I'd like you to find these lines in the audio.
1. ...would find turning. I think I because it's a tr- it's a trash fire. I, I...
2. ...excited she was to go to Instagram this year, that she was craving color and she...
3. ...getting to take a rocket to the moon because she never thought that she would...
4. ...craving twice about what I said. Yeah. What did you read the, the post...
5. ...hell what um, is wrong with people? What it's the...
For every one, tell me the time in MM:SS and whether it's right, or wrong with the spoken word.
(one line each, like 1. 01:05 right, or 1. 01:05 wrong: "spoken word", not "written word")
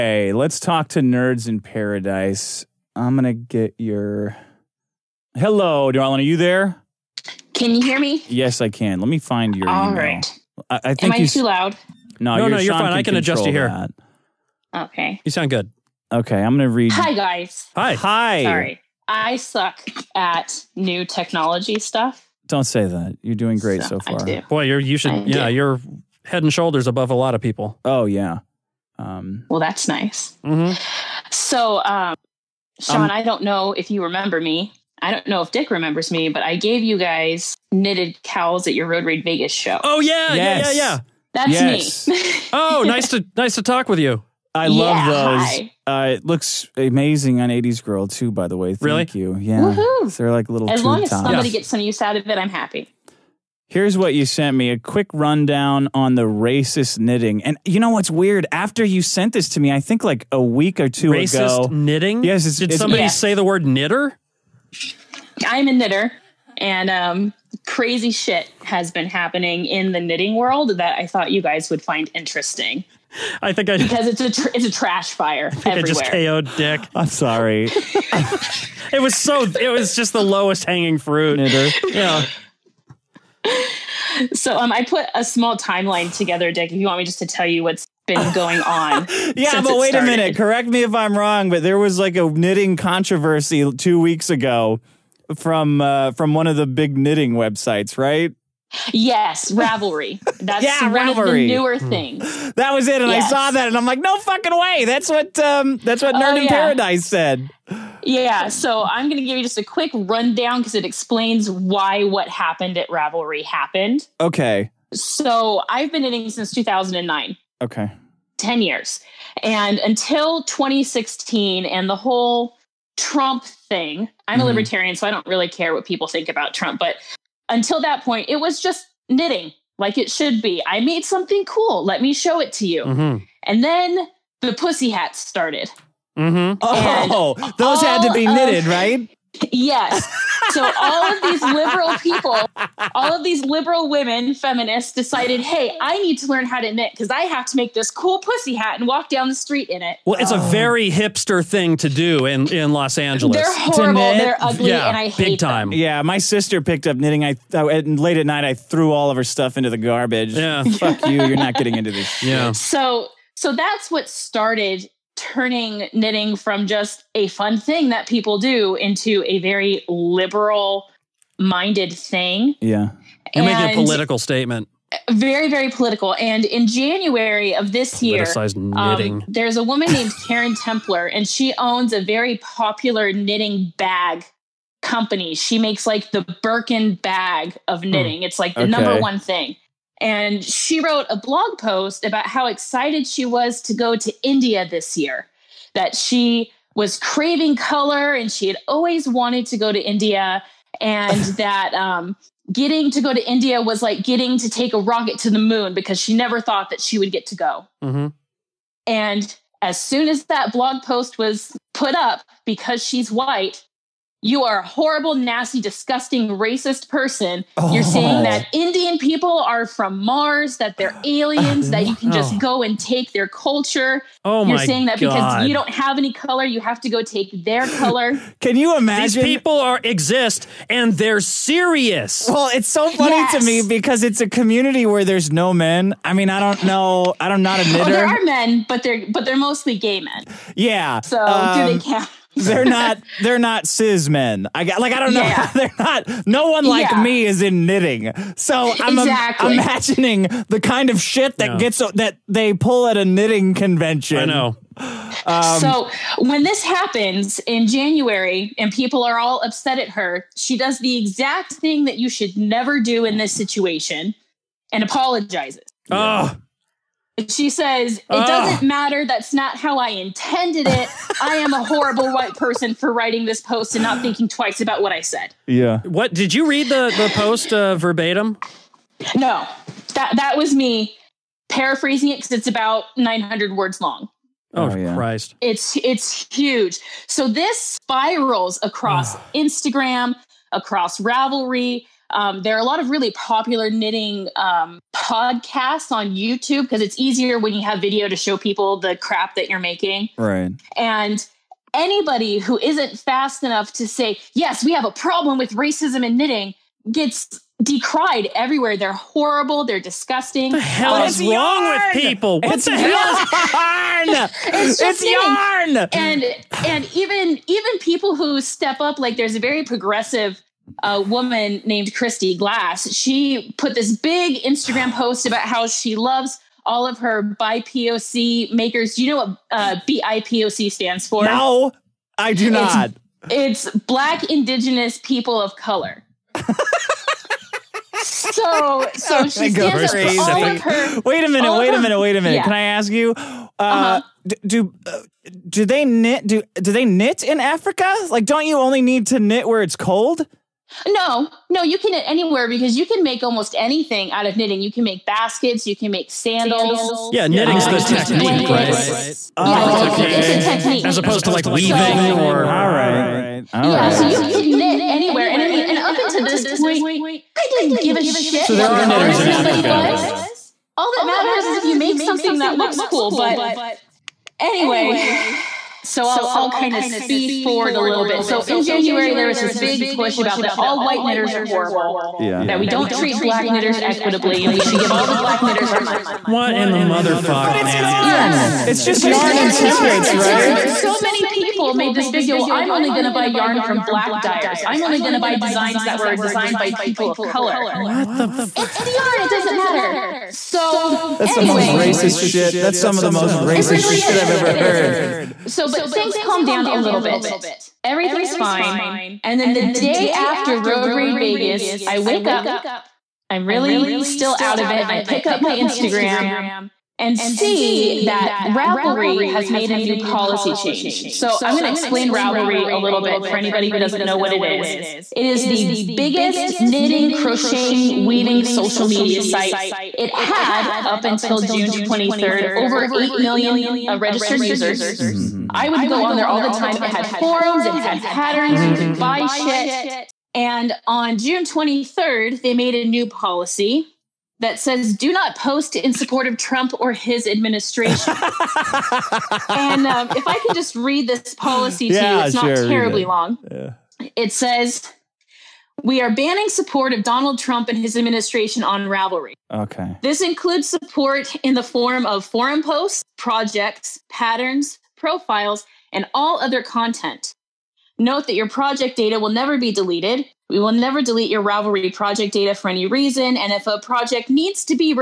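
1. 01:11 wrong: "interesting", not "turning"
2. 03:12 wrong: "India", not "Instagram"
3. 03:24 right
4. 04:34 wrong: "thinking", not "craving"
5. 05:10 right.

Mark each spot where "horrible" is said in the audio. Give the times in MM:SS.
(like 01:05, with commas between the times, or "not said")
02:33, 03:34, 04:31, 05:08, 06:21.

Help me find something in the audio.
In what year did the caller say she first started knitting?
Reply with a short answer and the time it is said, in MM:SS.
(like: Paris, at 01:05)
2009, at 01:56.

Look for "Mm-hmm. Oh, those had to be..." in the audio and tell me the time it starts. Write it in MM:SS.
02:16.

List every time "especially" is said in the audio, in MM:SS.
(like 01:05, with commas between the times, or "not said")
not said.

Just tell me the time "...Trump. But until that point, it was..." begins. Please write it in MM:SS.
02:06.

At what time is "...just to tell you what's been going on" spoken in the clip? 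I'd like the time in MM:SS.
01:27.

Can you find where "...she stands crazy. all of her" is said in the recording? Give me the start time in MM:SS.
05:39.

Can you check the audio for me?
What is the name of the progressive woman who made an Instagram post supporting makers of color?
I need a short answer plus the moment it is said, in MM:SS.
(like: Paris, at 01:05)
Christy Glass, at 05:21.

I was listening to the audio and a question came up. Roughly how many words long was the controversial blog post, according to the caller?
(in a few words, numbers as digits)
900.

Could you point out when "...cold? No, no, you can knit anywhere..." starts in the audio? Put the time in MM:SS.
05:49.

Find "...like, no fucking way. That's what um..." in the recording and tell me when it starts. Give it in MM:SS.
01:43.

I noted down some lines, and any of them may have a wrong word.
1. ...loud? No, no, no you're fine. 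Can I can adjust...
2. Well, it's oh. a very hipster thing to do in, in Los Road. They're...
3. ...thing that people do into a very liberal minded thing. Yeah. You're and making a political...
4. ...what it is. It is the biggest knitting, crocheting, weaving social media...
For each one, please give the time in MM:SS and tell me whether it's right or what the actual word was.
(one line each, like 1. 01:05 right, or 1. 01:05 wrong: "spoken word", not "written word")
1. 00:11 right
2. 02:30 wrong: "Angeles", not "Road"
3. 02:47 right
4. 07:04 right.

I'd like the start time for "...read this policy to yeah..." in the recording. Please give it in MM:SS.
07:30.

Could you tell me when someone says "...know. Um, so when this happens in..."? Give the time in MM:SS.
04:14.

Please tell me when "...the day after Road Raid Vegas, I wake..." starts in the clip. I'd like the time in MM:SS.
06:49.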